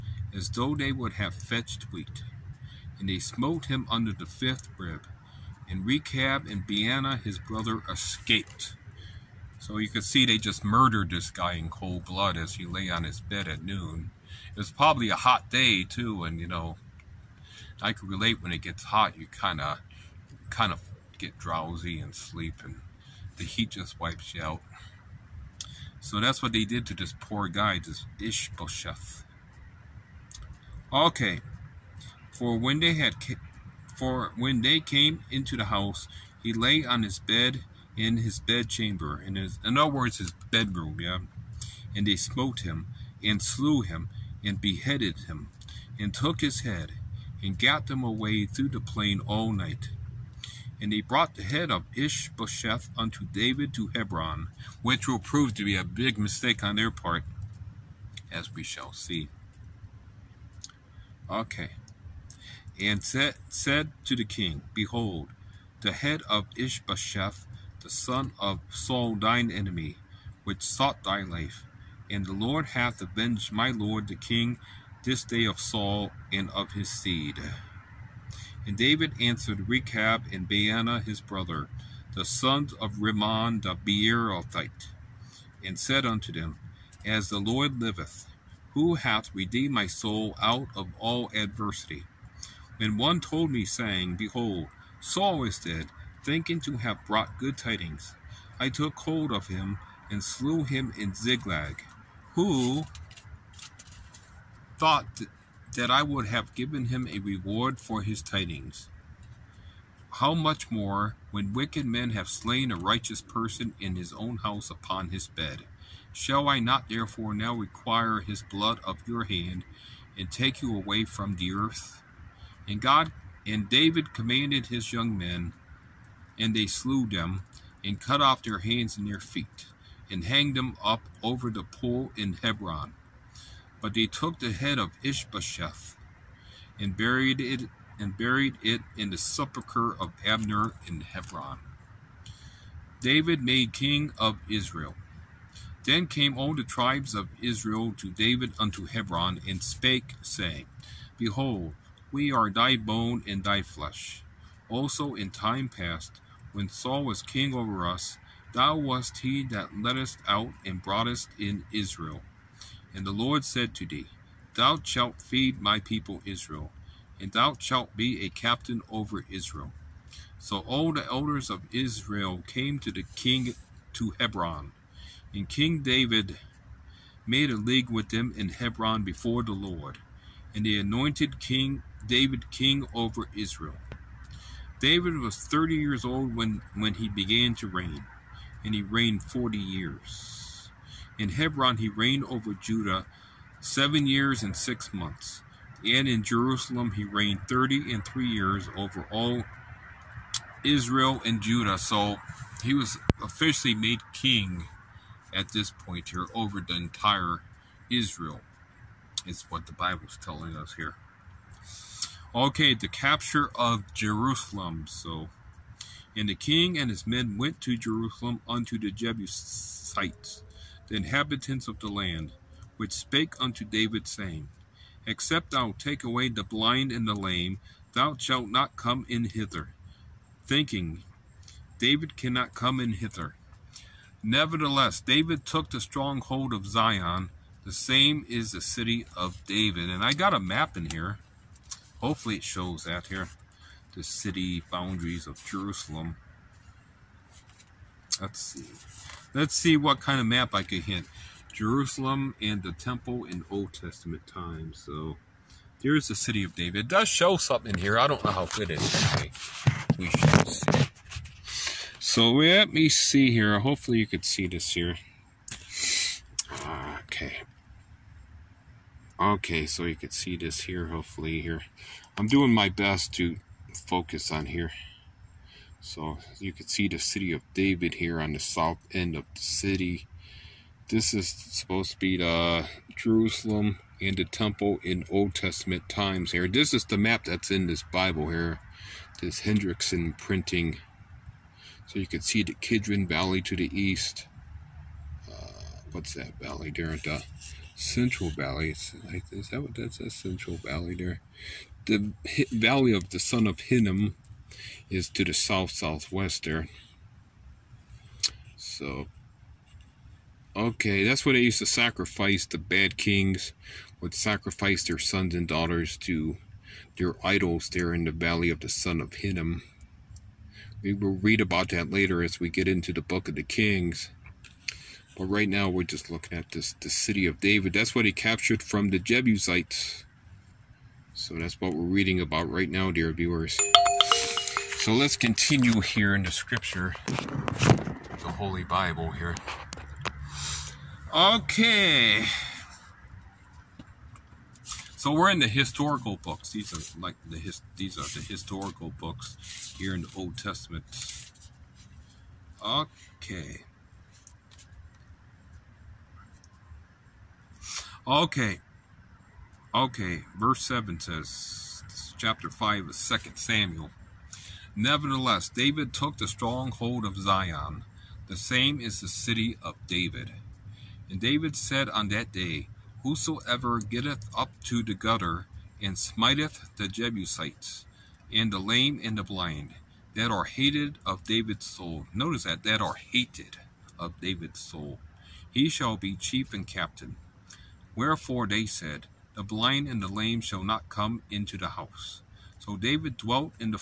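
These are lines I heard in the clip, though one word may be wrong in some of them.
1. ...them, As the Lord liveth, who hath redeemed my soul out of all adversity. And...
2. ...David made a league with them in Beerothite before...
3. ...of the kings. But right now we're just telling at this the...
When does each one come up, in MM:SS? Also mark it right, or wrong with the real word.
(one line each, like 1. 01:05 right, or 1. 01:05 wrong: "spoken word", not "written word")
1. 01:26 right
2. 02:55 wrong: "Hebron", not "Beerothite"
3. 05:23 wrong: "looking", not "telling".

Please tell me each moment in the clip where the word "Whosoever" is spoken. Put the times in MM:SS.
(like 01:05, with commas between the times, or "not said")
06:13.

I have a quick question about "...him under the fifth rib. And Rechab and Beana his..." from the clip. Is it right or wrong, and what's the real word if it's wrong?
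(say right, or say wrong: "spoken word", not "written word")
right.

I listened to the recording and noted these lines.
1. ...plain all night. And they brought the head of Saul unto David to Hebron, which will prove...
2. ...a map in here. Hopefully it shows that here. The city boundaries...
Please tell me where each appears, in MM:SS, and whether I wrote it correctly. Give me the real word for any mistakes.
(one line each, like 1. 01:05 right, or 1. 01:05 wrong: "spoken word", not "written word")
1. 00:48 wrong: "Ishbosheth", not "Saul"
2. 04:00 right.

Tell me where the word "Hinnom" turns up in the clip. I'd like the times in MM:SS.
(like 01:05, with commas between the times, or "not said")
05:03, 05:19.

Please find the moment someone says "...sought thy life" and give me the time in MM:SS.
01:10.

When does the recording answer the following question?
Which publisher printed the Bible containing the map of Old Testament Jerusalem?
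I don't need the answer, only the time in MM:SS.
04:49.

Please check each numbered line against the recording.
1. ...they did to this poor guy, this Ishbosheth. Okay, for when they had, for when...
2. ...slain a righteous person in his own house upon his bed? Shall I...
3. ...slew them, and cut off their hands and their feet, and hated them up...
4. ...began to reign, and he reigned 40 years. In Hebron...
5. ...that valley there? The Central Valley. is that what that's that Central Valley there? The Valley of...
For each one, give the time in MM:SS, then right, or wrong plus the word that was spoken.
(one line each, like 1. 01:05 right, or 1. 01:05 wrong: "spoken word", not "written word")
1. 00:26 right
2. 01:52 right
3. 02:06 wrong: "hanged", not "hated"
4. 03:07 right
5. 04:56 right.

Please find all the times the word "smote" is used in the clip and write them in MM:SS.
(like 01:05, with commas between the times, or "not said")
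00:03, 00:42.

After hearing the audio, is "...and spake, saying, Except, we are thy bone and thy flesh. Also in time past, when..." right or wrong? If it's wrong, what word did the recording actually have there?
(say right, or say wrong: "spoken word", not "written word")
wrong: "Behold", not "Except".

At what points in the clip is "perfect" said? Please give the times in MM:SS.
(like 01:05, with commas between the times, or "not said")
not said.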